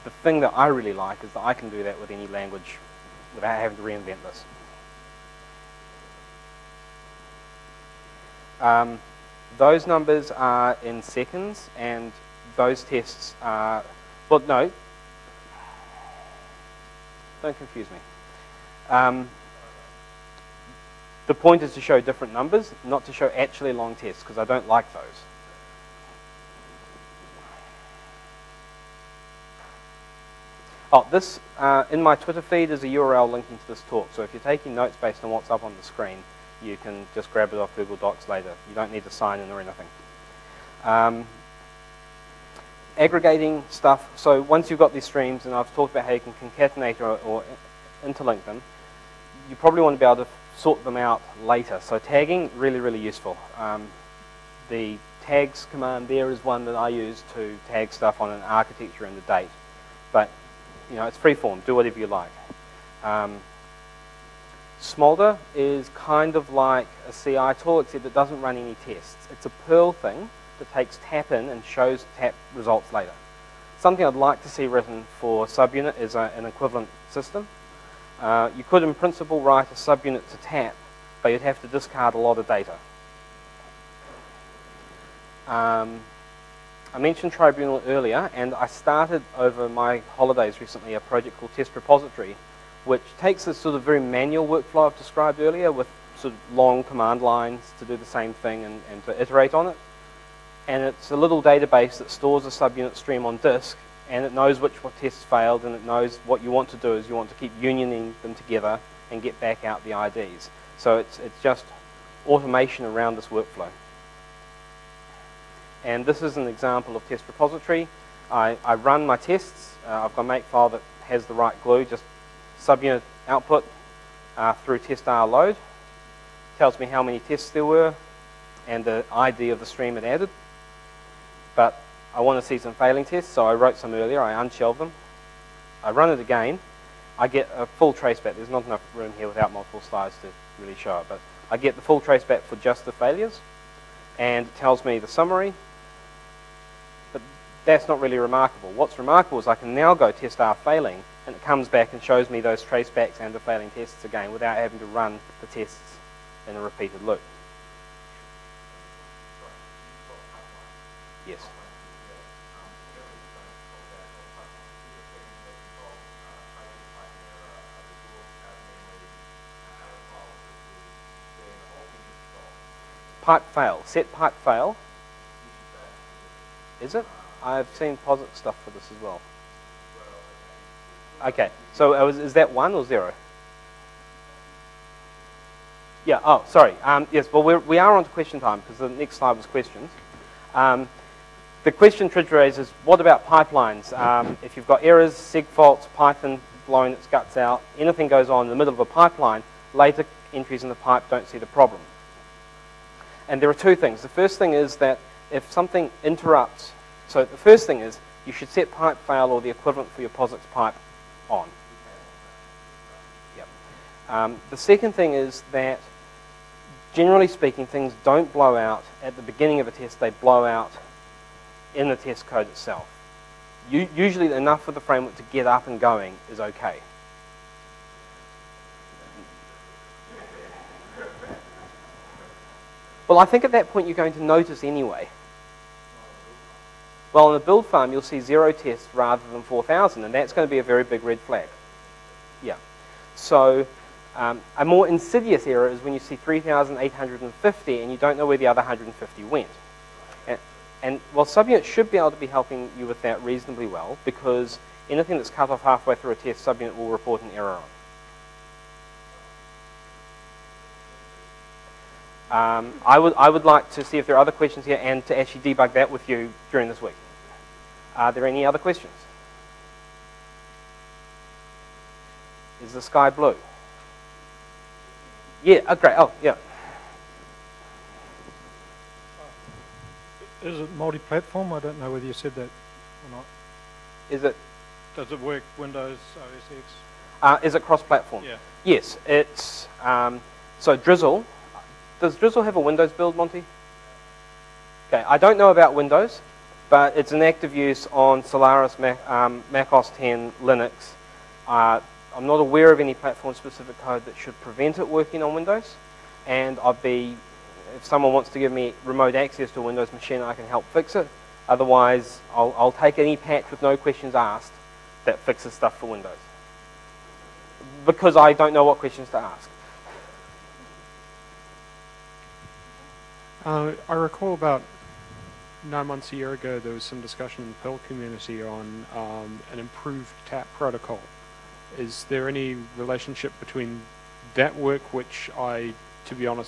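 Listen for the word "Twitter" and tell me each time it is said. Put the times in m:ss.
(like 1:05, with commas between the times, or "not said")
0:32.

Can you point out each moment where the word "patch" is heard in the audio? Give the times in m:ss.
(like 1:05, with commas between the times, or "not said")
5:13.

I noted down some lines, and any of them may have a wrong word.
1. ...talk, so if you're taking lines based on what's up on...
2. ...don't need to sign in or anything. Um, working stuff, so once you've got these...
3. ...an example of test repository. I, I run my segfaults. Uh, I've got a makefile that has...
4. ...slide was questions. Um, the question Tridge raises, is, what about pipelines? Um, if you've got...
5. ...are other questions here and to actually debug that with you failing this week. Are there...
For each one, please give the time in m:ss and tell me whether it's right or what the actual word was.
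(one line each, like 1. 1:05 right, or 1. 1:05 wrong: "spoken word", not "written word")
1. 0:33 wrong: "notes", not "lines"
2. 0:38 wrong: "aggregating", not "working"
3. 1:56 wrong: "tests", not "segfaults"
4. 3:09 right
5. 4:24 wrong: "during", not "failing".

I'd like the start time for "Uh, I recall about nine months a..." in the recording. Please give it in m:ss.
5:23.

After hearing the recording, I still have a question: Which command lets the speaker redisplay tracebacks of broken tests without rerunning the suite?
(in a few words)
testr failing.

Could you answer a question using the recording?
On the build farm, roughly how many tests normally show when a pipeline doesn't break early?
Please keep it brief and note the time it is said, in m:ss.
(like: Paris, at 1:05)
4,000, at 3:59.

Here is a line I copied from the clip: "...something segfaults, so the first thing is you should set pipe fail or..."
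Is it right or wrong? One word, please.
wrong.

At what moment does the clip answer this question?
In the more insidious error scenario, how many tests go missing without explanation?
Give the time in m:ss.
4:08.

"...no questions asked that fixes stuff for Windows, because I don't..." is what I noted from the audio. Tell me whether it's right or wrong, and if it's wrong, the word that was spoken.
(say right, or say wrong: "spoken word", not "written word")
right.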